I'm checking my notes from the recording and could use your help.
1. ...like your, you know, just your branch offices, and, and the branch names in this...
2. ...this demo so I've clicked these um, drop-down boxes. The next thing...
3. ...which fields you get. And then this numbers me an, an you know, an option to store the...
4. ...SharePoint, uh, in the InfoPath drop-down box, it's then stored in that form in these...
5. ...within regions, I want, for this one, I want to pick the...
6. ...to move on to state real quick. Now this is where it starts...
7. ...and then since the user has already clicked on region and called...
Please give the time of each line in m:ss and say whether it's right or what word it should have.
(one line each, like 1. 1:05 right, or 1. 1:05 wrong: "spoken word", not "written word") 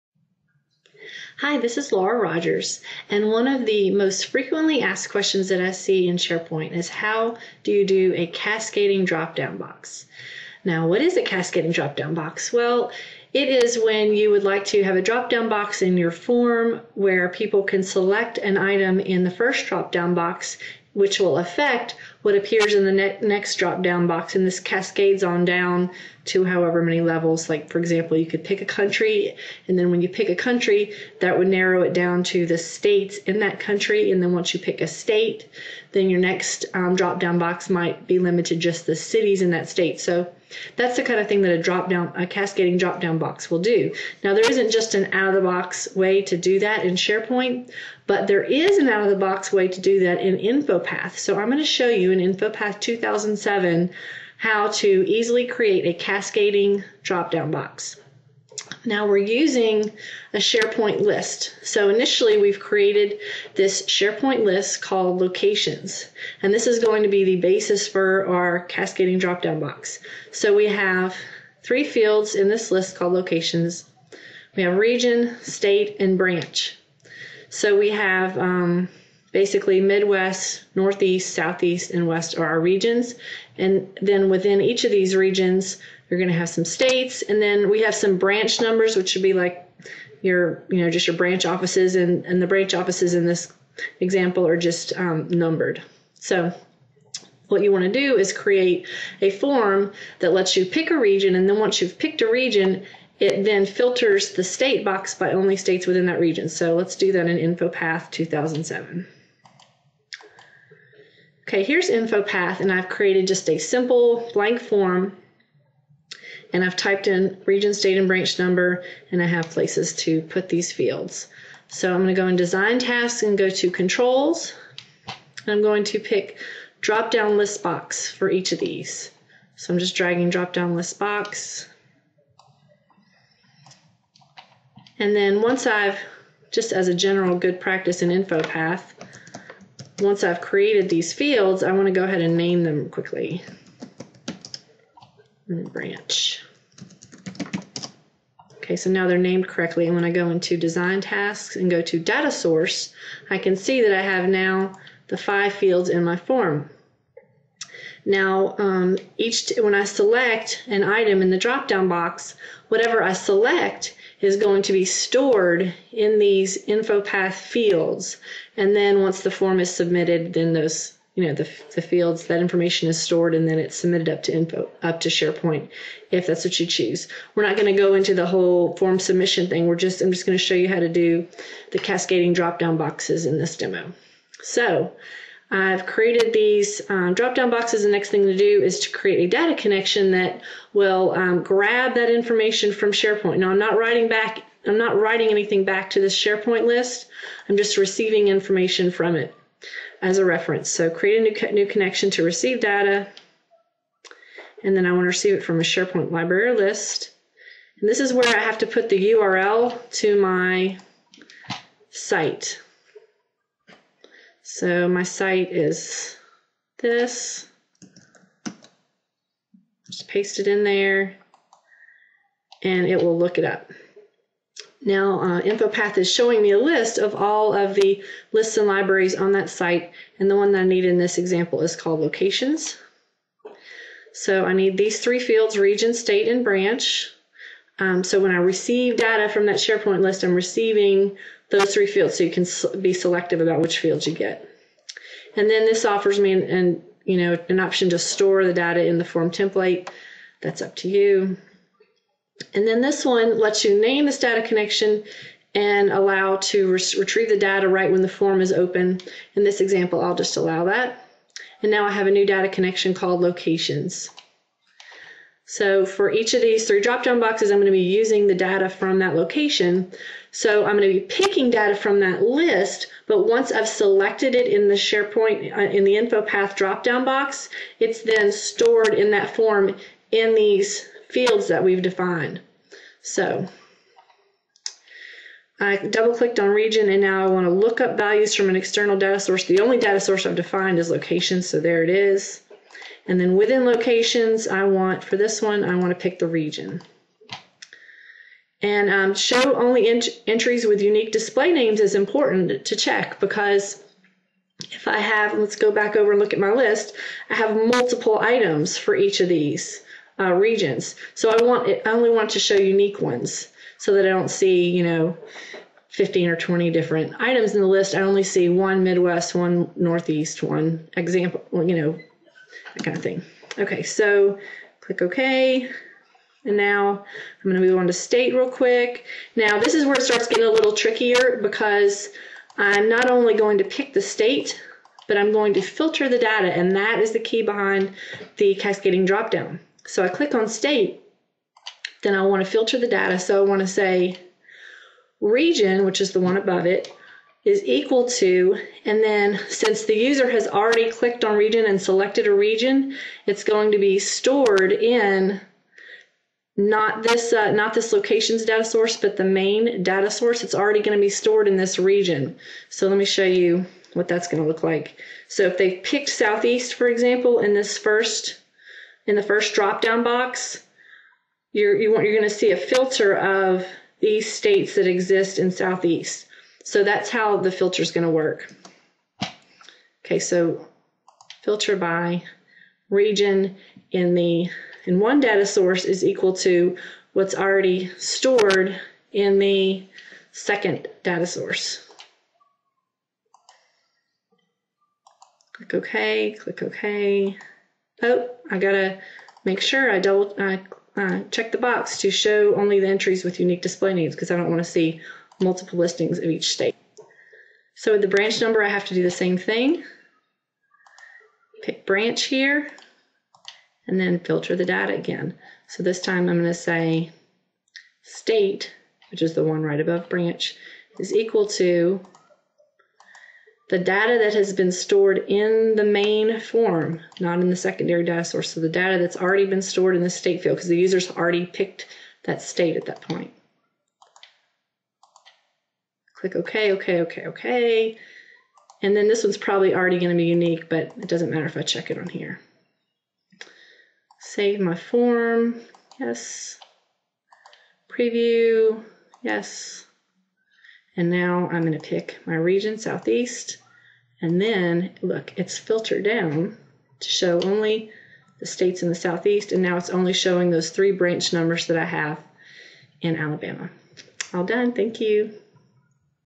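1. 1:29 wrong: "offices", not "names"
2. 3:03 wrong: "created", not "clicked"
3. 4:03 wrong: "offers", not "numbers"
4. 4:34 right
5. 4:53 wrong: "locations", not "regions"
6. 5:27 right
7. 5:48 wrong: "selected", not "called".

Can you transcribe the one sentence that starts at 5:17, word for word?
I only see one Midwest, one Northeast, one example, you know, that kind of thing.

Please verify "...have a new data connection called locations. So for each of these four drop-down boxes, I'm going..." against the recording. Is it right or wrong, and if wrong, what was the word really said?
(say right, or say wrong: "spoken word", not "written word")
wrong: "three", not "four".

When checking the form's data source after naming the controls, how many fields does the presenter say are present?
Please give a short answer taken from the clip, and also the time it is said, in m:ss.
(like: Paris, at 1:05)
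5, at 2:35.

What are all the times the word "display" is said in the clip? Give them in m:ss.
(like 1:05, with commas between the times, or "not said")
5:01, 6:43.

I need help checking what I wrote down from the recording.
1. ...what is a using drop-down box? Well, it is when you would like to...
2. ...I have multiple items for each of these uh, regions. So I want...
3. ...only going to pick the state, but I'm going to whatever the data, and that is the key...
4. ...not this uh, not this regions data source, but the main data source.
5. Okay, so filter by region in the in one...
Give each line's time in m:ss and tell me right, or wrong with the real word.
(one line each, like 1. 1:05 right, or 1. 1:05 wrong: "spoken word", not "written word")
1. 0:10 wrong: "cascading", not "using"
2. 5:07 right
3. 5:33 wrong: "filter", not "whatever"
4. 5:56 wrong: "locations", not "regions"
5. 6:20 right.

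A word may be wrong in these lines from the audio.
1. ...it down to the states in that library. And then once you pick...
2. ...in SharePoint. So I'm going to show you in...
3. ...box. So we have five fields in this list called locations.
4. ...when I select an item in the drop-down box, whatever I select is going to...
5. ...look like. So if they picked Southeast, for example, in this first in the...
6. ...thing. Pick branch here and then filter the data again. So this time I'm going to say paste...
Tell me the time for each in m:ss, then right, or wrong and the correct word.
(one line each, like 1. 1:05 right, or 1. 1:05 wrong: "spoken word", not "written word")
1. 0:31 wrong: "country", not "library"
2. 0:50 wrong: "InfoPath", not "SharePoint"
3. 1:09 wrong: "three", not "five"
4. 2:39 right
5. 6:04 right
6. 6:49 wrong: "state", not "paste".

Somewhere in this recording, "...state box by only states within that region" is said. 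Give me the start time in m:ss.
1:44.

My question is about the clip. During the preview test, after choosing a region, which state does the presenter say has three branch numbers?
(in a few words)
Alabama.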